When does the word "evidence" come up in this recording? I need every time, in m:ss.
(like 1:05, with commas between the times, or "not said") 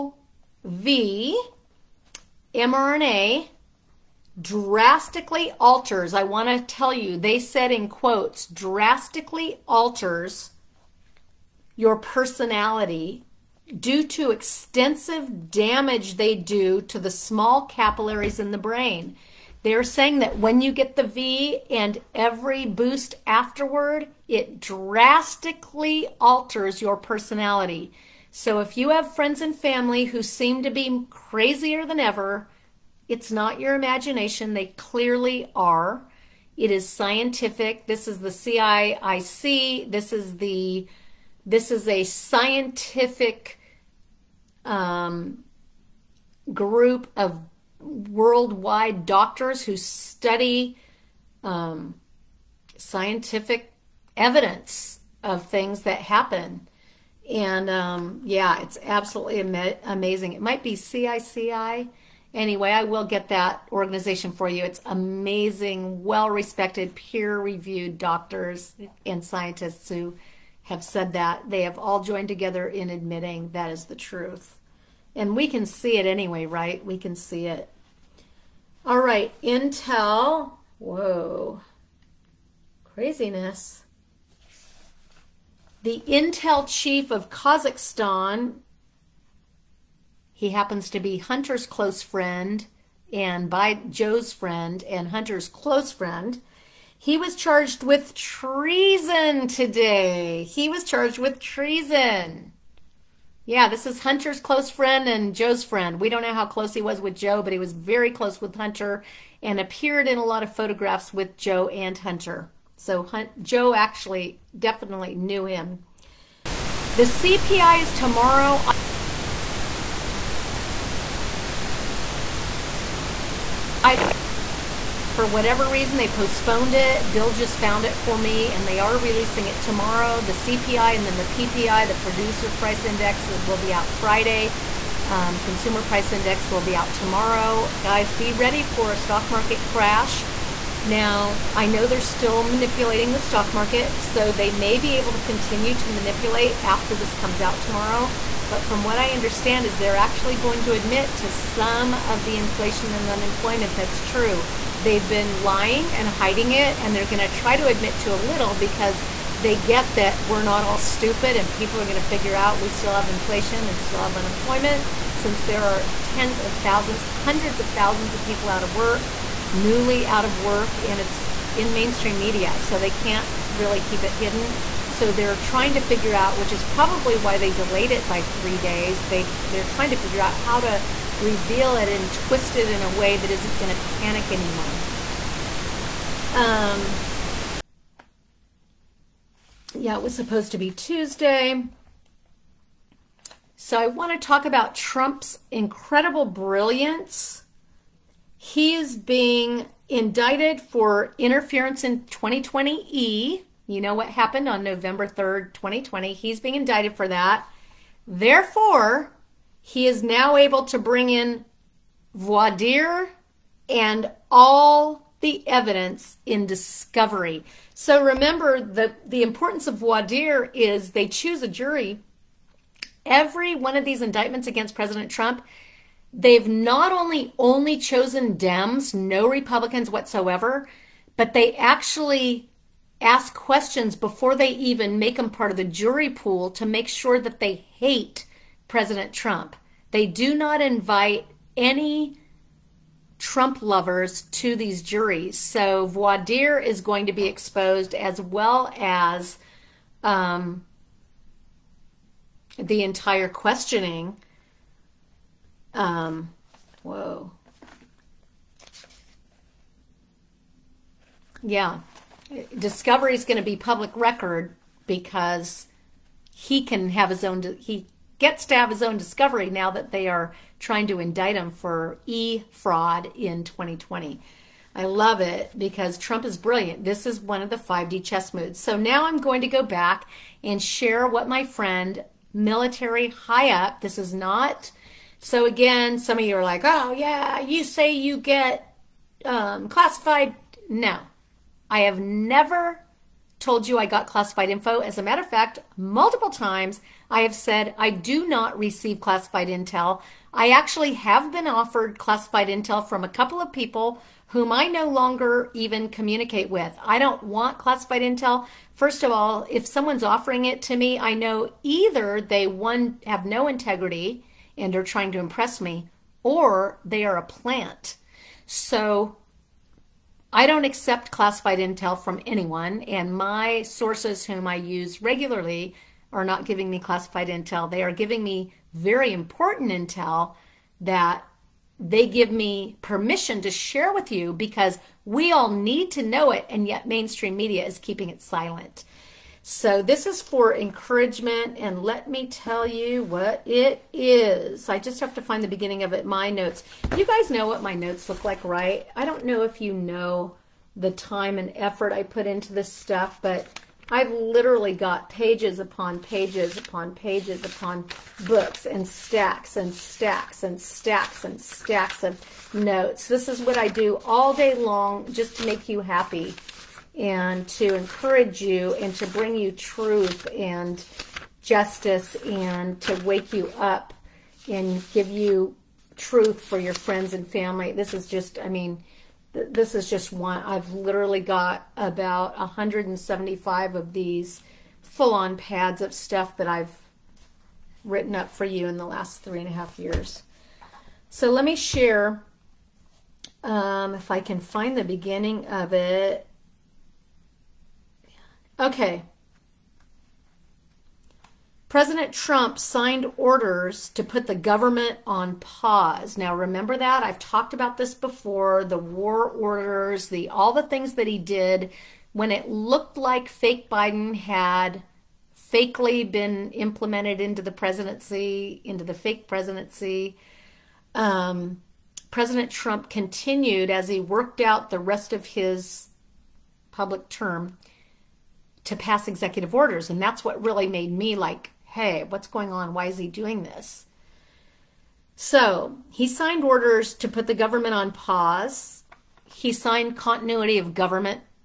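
0:54, 3:35.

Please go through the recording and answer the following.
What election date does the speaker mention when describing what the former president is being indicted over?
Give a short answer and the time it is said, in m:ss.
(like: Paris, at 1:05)
November 3rd, 2020, at 3:24.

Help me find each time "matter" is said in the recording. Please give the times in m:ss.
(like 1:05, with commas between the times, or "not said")
4:55.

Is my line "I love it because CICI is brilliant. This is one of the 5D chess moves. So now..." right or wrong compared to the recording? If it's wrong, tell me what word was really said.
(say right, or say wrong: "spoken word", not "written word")
wrong: "Trump", not "CICI".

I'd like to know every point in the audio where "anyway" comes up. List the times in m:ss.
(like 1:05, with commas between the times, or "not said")
1:02, 1:16.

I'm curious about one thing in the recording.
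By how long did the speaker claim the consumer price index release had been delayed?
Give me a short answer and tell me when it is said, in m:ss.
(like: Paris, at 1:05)
3 days, at 2:58.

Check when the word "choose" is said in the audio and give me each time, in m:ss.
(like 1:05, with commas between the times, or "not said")
3:41.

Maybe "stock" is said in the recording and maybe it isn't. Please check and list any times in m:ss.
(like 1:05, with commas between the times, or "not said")
2:18, 2:23.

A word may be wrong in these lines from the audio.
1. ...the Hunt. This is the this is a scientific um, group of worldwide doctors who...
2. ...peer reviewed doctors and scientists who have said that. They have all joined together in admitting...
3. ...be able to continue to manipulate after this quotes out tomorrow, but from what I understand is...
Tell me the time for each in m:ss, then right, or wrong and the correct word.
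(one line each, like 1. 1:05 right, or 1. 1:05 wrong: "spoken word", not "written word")
1. 0:38 wrong: "CIIC", not "Hunt"
2. 1:06 right
3. 2:24 wrong: "comes", not "quotes".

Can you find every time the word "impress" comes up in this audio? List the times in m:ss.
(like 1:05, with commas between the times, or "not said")
5:15.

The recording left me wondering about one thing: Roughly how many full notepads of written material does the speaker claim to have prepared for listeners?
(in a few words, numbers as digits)
175.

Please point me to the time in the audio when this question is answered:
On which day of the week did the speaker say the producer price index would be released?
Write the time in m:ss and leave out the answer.
2:13.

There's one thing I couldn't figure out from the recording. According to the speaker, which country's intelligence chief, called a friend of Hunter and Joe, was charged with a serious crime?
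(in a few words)
Kazakhstan.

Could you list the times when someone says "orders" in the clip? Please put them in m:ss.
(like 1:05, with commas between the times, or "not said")
6:43, 6:49, 7:09, 7:16.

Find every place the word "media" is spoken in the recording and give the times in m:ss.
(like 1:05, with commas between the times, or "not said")
2:52, 5:37.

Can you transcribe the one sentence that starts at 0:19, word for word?
They're saying that when you get the V and every boost afterward, it drastically alters your personality.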